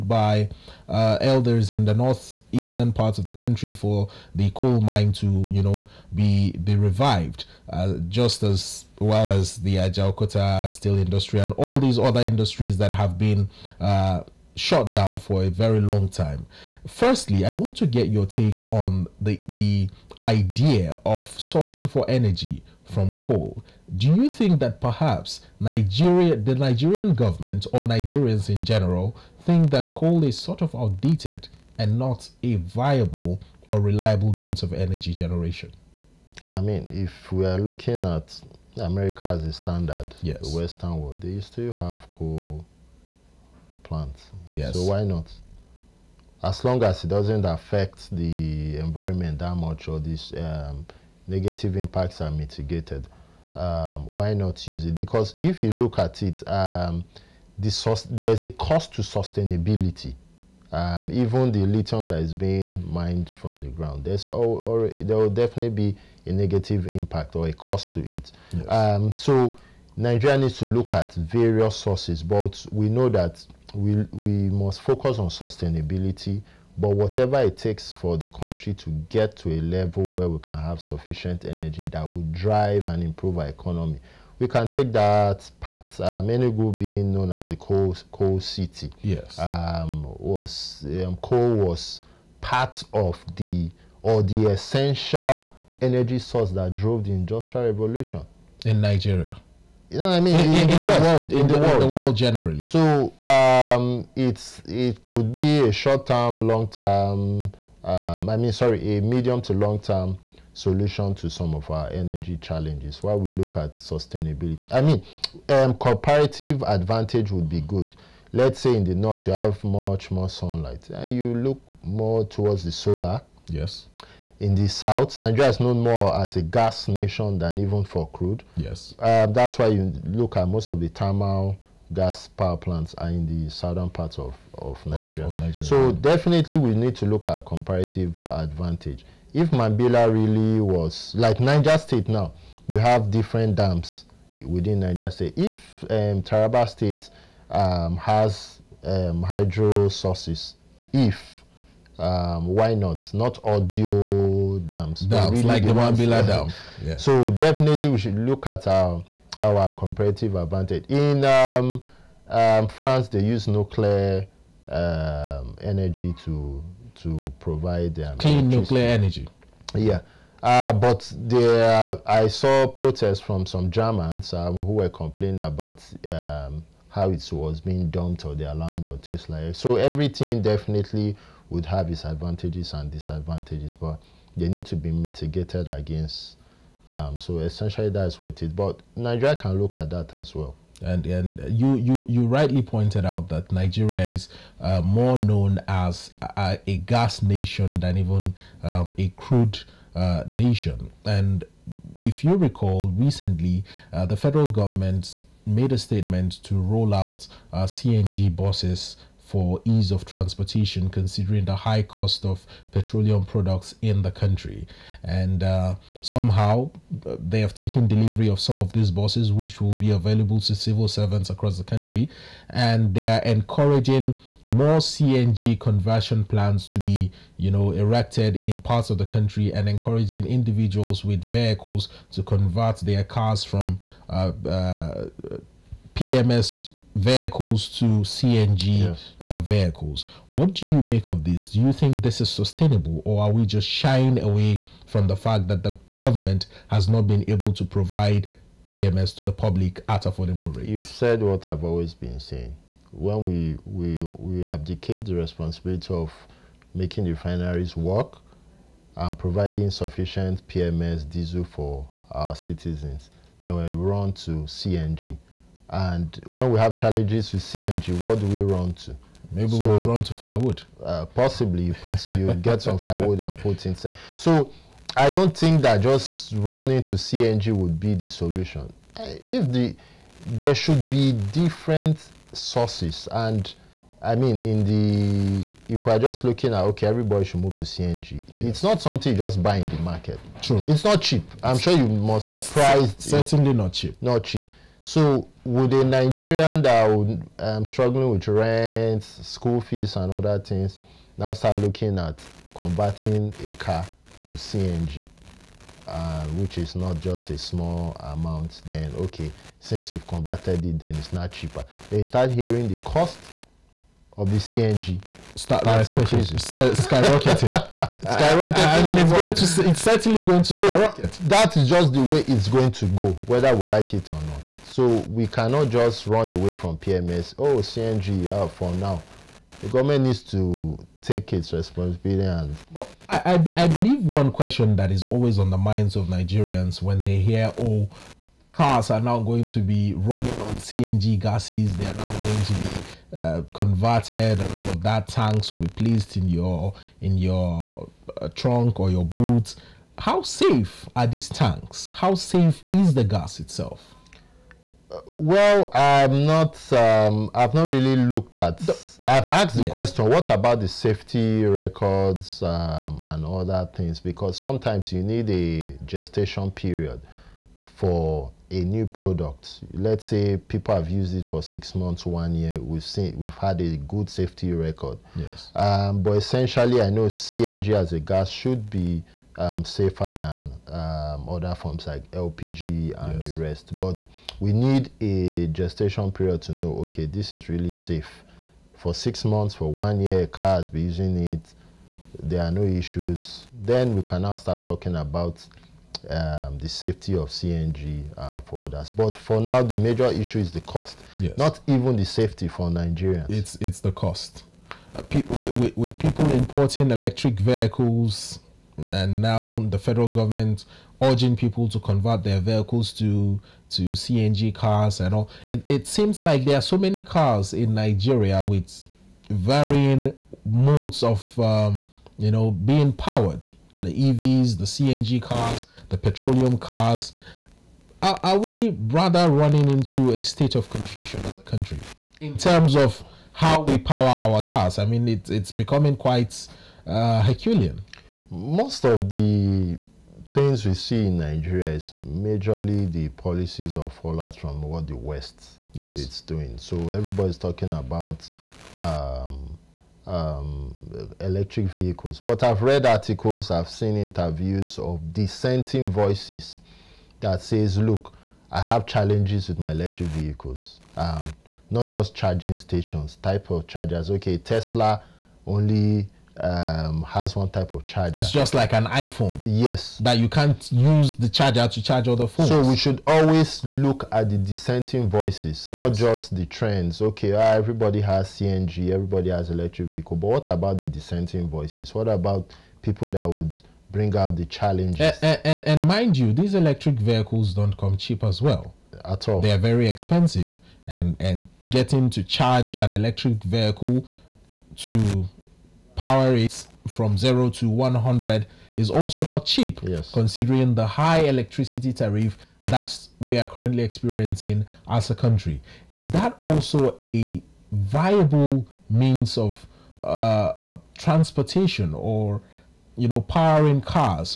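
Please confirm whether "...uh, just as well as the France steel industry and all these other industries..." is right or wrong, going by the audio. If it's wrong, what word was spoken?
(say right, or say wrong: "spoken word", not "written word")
wrong: "Ajaokuta", not "France".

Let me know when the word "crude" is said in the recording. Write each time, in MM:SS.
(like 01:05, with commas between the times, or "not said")
02:08, 03:19.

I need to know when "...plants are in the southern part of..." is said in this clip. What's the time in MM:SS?
02:12.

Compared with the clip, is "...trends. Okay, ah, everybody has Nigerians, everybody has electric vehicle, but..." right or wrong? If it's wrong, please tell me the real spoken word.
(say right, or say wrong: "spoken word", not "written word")
wrong: "CNG", not "Nigerians".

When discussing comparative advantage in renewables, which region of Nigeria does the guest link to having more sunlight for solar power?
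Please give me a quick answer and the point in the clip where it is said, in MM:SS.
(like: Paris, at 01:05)
the north, at 01:58.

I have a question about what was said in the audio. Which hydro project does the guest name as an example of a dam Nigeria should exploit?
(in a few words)
Mambila Dam.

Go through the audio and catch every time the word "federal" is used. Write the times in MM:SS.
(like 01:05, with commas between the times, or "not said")
03:24, 06:49.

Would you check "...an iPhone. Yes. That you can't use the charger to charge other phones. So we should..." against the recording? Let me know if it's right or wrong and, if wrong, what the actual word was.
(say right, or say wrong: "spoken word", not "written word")
right.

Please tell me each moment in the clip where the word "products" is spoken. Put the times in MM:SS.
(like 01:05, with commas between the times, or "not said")
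03:33, 06:08.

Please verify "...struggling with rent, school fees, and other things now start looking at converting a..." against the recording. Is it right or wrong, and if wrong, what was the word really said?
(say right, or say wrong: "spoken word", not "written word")
right.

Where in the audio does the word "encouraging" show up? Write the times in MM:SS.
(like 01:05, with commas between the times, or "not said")
03:43, 03:49.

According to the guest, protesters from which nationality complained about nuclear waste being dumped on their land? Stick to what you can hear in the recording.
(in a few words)
Germans.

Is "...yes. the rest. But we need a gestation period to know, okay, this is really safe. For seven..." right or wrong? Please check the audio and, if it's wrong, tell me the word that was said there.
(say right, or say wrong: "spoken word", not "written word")
wrong: "six", not "seven".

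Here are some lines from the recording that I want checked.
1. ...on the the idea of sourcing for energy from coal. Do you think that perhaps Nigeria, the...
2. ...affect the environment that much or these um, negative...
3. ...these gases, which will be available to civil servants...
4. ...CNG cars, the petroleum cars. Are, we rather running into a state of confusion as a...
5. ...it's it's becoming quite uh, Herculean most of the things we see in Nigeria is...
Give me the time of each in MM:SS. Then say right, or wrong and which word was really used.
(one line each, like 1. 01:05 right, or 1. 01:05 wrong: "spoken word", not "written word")
1. 00:18 right
2. 00:47 right
3. 03:38 wrong: "buses", not "gases"
4. 07:04 right
5. 07:15 right.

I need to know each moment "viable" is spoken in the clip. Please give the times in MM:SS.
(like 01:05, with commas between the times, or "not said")
00:32, 08:27.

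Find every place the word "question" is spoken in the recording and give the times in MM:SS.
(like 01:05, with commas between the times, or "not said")
05:34, 05:59.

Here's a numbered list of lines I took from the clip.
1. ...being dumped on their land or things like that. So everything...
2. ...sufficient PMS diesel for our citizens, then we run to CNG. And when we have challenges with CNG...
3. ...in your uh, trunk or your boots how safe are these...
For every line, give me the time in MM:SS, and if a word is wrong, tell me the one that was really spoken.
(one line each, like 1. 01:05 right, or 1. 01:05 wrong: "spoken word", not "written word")
1. 02:57 right
2. 04:19 right
3. 05:47 right.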